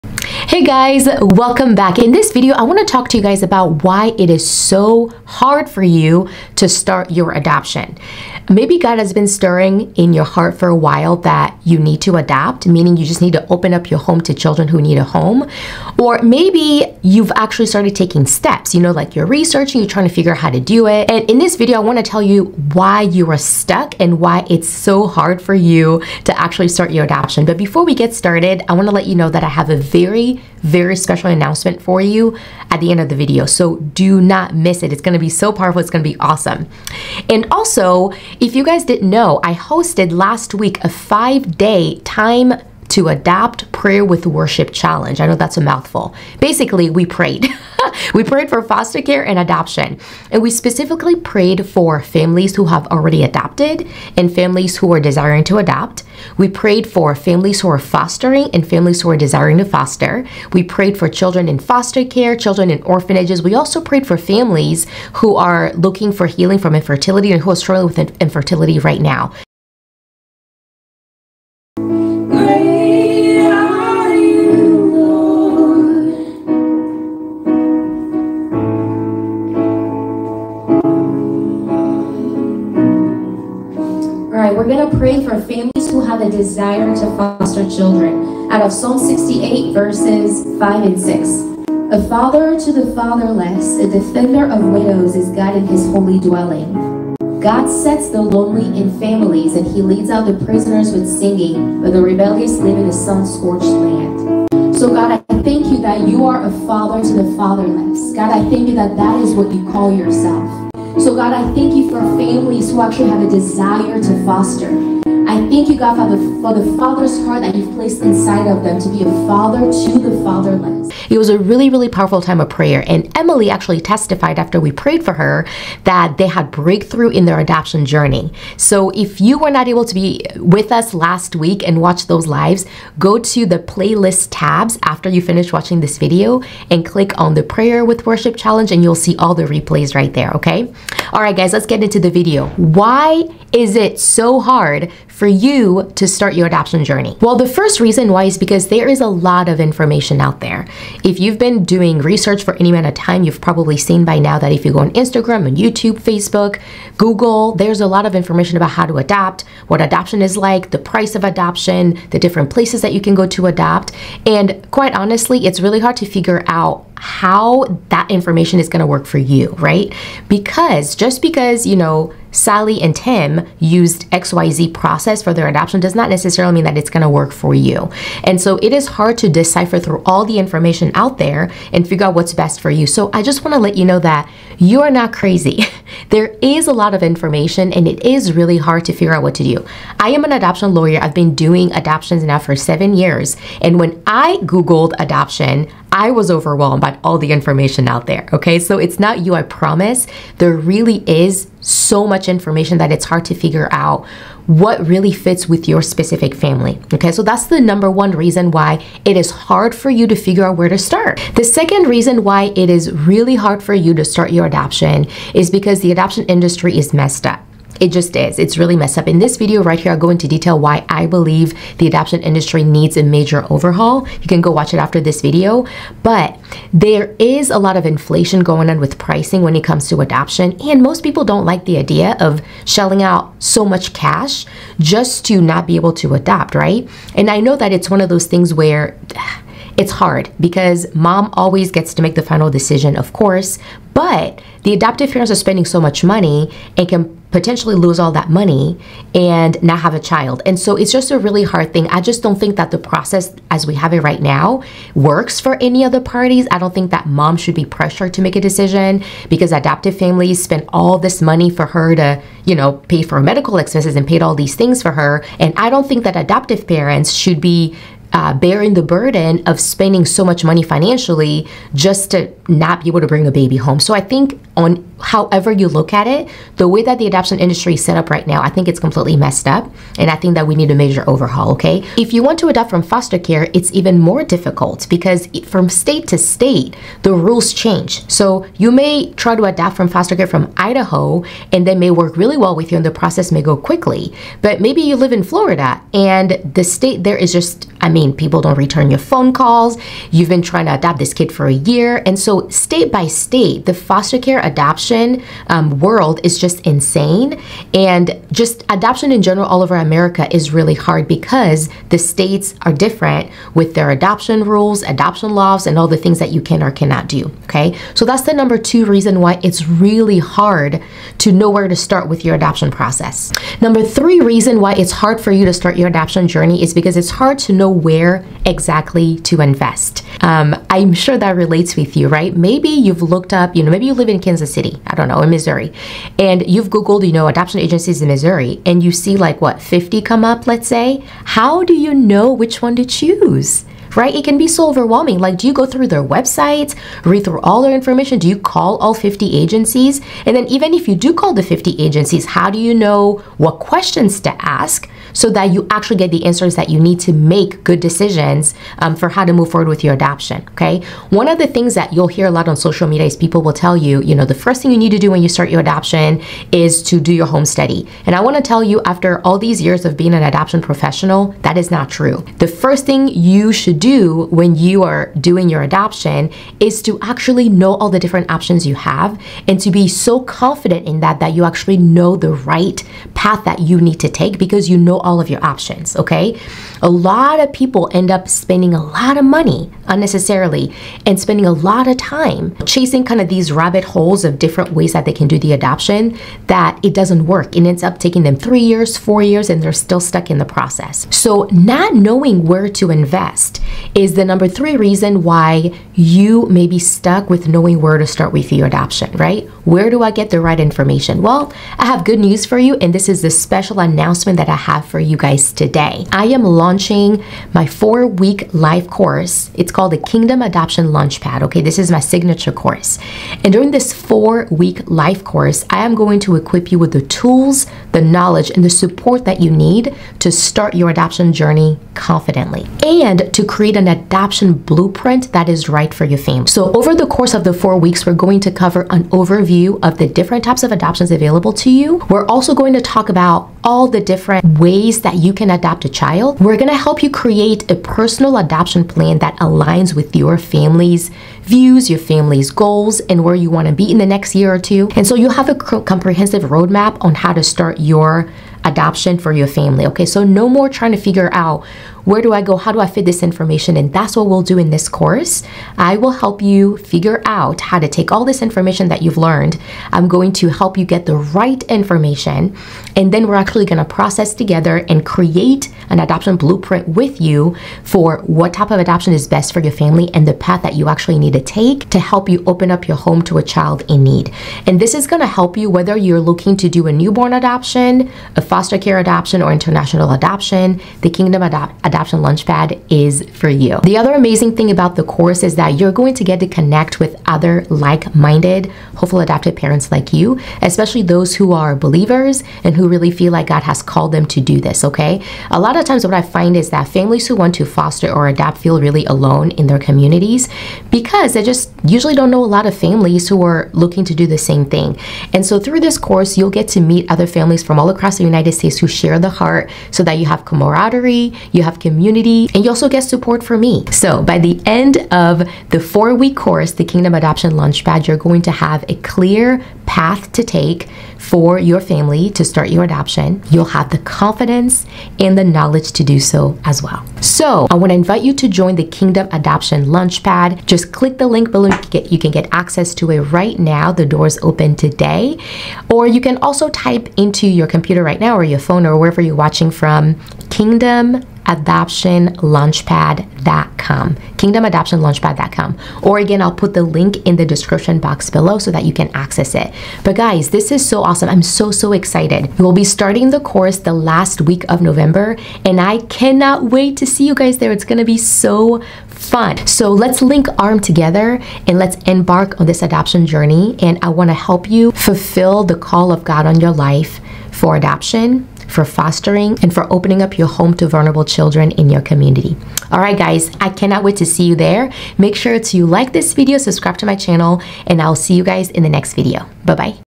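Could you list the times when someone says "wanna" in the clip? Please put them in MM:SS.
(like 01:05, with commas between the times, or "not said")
00:02, 00:21, 00:28, 07:33, 08:57, 09:34.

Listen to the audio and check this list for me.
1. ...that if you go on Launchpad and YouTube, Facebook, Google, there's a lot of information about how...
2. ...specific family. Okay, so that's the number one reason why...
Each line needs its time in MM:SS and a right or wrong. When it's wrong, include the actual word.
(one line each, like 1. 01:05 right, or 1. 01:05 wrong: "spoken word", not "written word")
1. 02:34 wrong: "Instagram", not "Launchpad"
2. 03:25 right.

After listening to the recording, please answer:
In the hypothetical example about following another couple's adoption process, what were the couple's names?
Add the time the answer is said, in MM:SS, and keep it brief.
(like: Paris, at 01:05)
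Sally and Tim, at 02:52.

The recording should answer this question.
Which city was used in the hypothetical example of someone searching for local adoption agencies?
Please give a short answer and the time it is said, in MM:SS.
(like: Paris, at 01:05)
Kansas City, at 05:34.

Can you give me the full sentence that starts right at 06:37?
and ends up taking them three years, four years, and they're still stuck in the process.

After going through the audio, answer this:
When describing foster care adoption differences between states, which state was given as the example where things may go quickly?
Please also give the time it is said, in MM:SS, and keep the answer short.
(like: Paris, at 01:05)
Idaho, at 04:50.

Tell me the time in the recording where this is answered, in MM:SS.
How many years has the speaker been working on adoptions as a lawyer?
03:12.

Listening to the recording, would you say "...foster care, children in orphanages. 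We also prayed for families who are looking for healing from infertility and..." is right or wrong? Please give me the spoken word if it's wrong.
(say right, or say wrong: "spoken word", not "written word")
right.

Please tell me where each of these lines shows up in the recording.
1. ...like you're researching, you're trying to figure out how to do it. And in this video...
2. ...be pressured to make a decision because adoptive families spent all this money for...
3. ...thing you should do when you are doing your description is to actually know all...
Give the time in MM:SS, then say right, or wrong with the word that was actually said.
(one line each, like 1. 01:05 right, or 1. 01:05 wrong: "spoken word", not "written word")
1. 00:18 right
2. 04:17 right
3. 06:12 wrong: "adoption", not "description".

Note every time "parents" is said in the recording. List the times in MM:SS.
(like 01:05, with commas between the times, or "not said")
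04:05, 04:26, 08:19.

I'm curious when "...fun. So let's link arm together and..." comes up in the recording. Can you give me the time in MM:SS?
09:29.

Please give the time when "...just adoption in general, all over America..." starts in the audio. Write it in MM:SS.
05:08.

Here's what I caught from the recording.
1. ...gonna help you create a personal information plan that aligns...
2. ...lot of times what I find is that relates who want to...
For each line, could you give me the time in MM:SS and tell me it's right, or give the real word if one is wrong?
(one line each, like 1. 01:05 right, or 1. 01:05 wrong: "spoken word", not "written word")
1. 07:26 wrong: "adoption", not "information"
2. 08:25 wrong: "families", not "relates".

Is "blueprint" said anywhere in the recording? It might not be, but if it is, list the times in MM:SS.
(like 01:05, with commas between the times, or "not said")
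07:14, 07:56.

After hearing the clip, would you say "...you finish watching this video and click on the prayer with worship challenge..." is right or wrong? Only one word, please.
right.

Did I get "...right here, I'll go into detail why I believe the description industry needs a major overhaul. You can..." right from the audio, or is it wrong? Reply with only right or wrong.
wrong.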